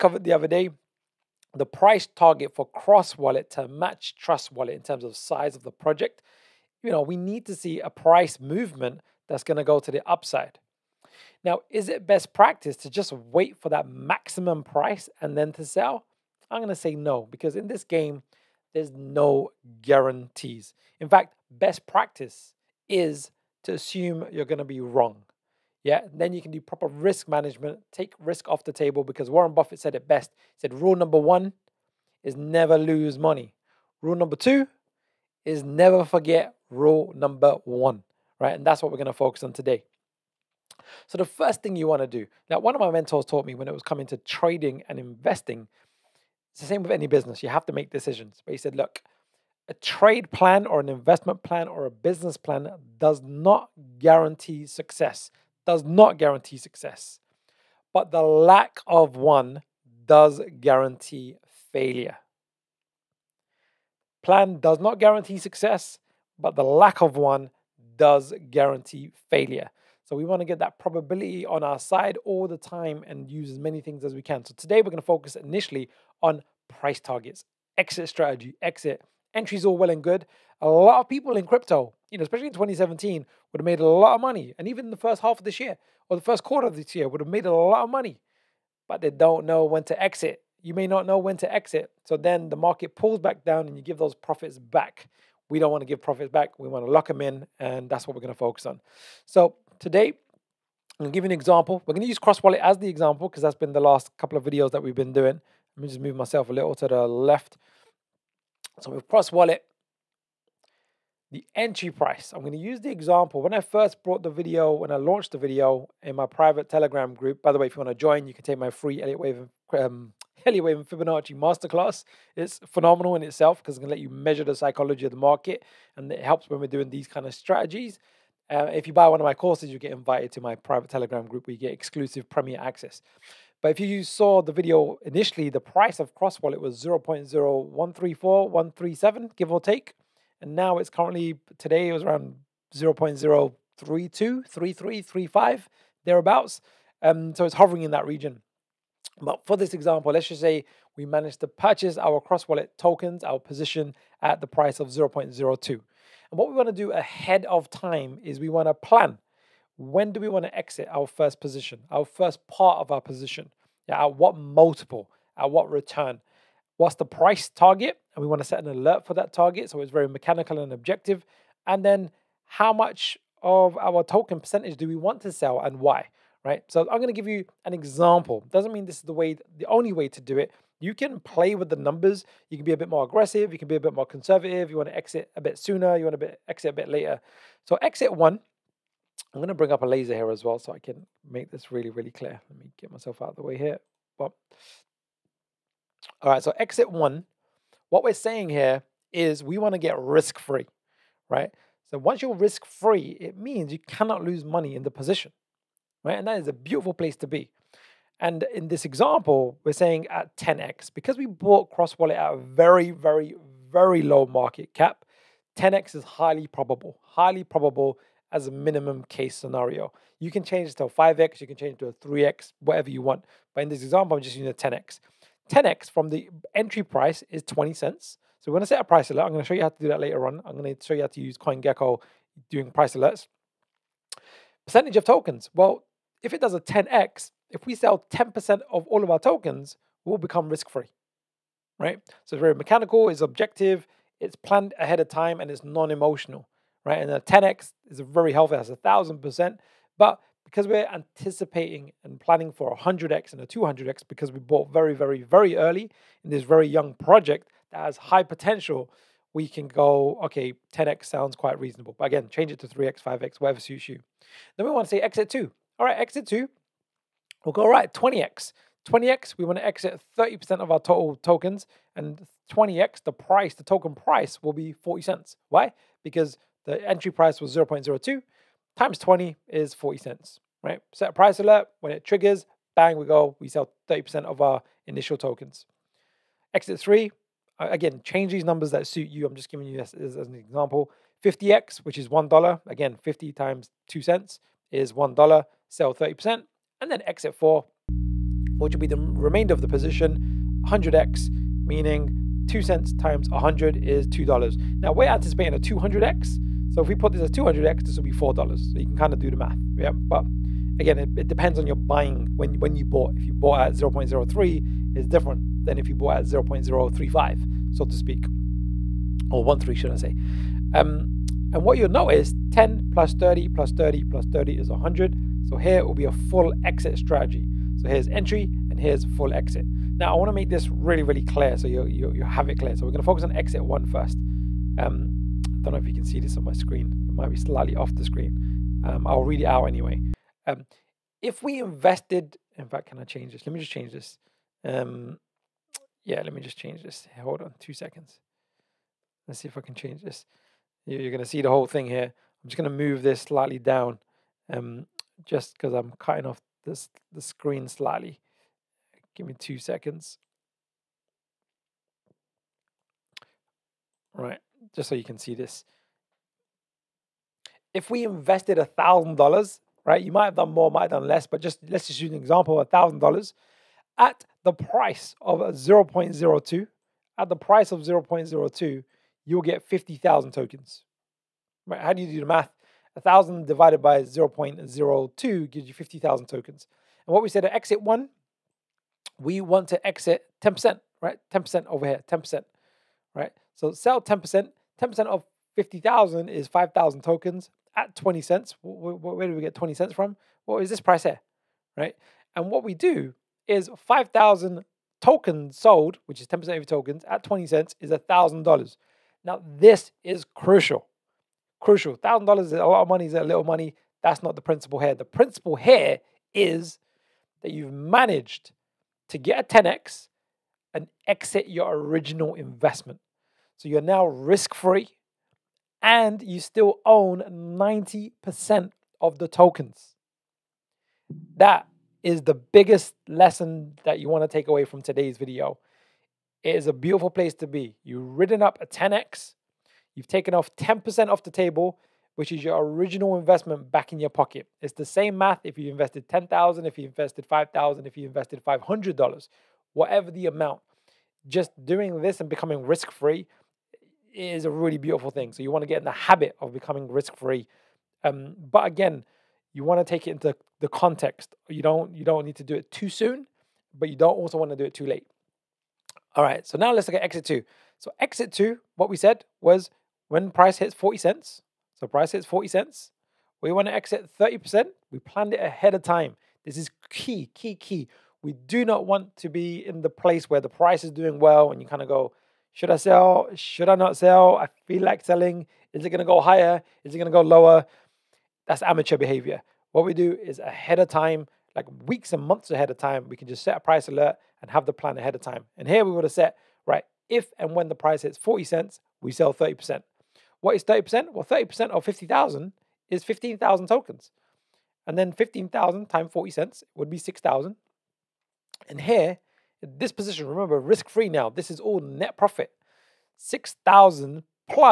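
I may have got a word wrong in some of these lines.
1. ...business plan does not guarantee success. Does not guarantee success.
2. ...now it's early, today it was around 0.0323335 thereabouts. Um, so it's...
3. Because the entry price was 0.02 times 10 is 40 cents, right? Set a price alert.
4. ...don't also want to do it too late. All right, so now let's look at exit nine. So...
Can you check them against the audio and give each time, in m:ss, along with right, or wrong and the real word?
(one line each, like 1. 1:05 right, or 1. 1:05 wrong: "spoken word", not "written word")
1. 0:51 right
2. 2:20 wrong: "currently", not "early"
3. 4:36 wrong: "20", not "10"
4. 7:43 wrong: "two", not "nine".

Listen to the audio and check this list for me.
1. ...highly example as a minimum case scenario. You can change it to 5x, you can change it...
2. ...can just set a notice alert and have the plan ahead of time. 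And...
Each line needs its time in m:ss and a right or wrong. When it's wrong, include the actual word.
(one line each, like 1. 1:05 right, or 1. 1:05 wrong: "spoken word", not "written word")
1. 3:37 wrong: "probable", not "example"
2. 8:13 wrong: "price", not "notice".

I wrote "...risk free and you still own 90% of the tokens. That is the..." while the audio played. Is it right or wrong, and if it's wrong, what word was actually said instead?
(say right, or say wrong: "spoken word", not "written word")
right.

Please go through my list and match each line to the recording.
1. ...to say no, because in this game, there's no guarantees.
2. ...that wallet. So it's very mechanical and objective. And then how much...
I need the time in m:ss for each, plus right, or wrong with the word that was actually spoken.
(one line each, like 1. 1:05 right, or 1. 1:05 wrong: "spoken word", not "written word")
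1. 0:16 right
2. 2:49 wrong: "target", not "wallet".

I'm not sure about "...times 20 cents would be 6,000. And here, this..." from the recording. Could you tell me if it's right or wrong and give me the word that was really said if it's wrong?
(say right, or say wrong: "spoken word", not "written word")
wrong: "40", not "20".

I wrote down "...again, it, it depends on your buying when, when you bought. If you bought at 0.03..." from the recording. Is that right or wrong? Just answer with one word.
right.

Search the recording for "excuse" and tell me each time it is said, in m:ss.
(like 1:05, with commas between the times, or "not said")
not said.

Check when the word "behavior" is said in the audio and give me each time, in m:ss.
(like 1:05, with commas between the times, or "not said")
8:08.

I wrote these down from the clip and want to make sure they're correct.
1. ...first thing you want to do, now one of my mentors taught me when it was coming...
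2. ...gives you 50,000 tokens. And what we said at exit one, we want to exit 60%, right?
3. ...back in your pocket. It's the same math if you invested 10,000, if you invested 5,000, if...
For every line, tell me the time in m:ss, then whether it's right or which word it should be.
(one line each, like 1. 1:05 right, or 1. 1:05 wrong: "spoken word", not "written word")
1. 0:41 right
2. 6:25 wrong: "10", not "60"
3. 7:23 right.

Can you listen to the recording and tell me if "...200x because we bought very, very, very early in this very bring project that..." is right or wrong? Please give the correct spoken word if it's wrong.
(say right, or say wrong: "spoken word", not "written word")
wrong: "young", not "bring".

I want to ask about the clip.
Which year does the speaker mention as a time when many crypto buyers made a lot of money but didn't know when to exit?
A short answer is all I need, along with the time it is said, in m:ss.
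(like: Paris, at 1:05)
2017, at 1:22.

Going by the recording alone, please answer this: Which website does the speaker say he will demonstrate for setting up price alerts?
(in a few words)
CoinGecko.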